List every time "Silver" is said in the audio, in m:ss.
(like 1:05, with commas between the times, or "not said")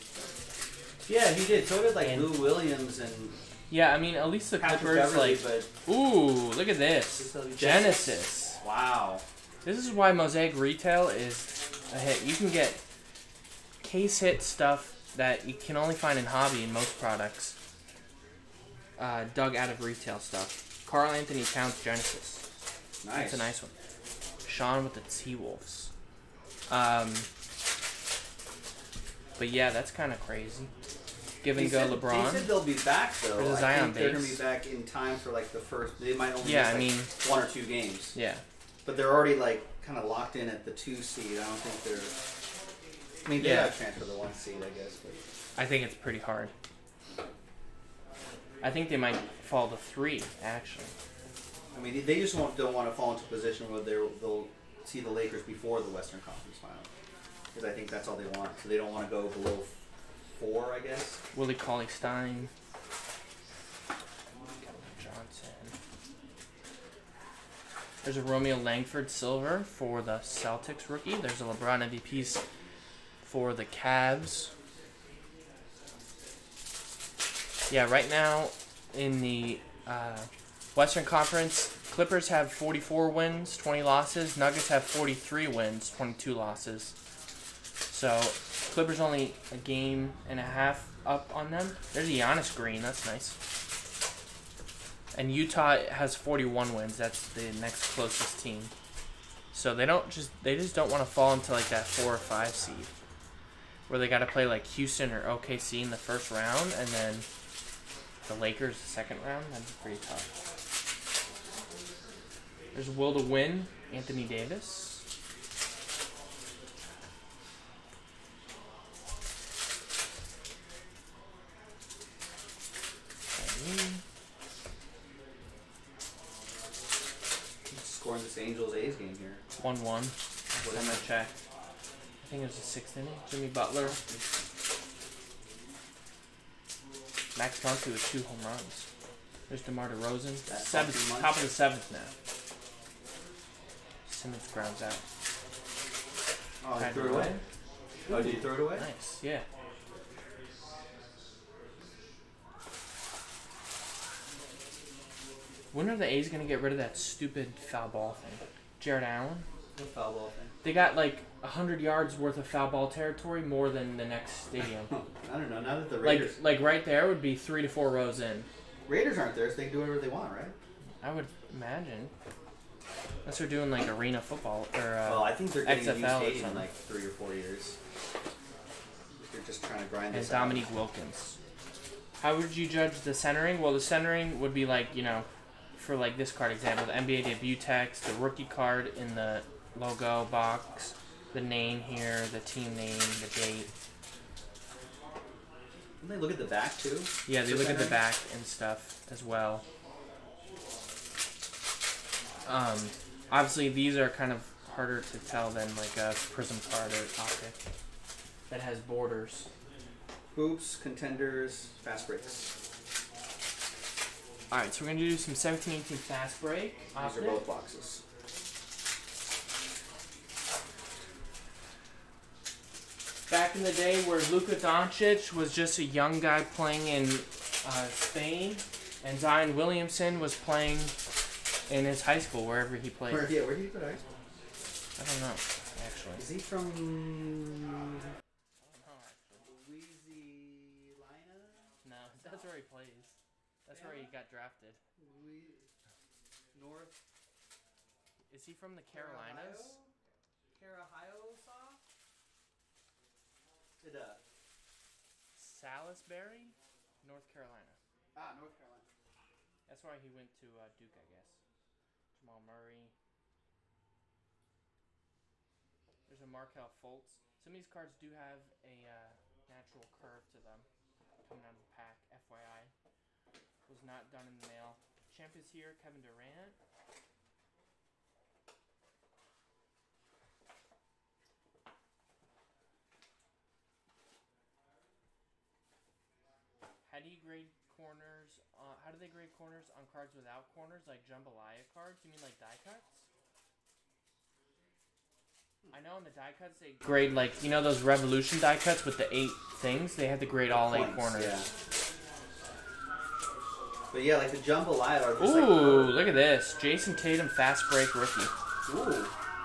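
1:09.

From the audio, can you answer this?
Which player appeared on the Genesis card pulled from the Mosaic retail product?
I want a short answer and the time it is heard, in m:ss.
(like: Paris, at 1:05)
Karl-Anthony Towns, at 0:20.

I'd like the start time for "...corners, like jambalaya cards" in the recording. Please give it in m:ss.
4:50.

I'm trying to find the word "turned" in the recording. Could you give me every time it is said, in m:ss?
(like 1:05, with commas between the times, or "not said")
not said.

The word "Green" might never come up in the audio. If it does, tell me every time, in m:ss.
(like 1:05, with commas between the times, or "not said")
1:32.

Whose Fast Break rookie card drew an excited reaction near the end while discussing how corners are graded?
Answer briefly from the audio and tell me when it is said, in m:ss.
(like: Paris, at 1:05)
Jayson Tatum, at 5:06.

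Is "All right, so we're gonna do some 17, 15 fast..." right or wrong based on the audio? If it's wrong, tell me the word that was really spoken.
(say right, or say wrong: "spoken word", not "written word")
wrong: "18", not "15".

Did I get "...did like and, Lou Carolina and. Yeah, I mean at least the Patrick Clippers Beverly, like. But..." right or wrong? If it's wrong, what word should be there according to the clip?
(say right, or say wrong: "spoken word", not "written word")
wrong: "Williams", not "Carolina".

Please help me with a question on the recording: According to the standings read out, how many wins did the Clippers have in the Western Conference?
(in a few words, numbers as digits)
44.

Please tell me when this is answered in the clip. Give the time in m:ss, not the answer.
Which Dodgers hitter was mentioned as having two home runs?
2:17.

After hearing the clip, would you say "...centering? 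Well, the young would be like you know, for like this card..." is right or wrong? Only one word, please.
wrong.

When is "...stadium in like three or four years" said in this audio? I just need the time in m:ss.
2:56.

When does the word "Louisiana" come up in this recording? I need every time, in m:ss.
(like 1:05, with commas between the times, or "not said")
4:00.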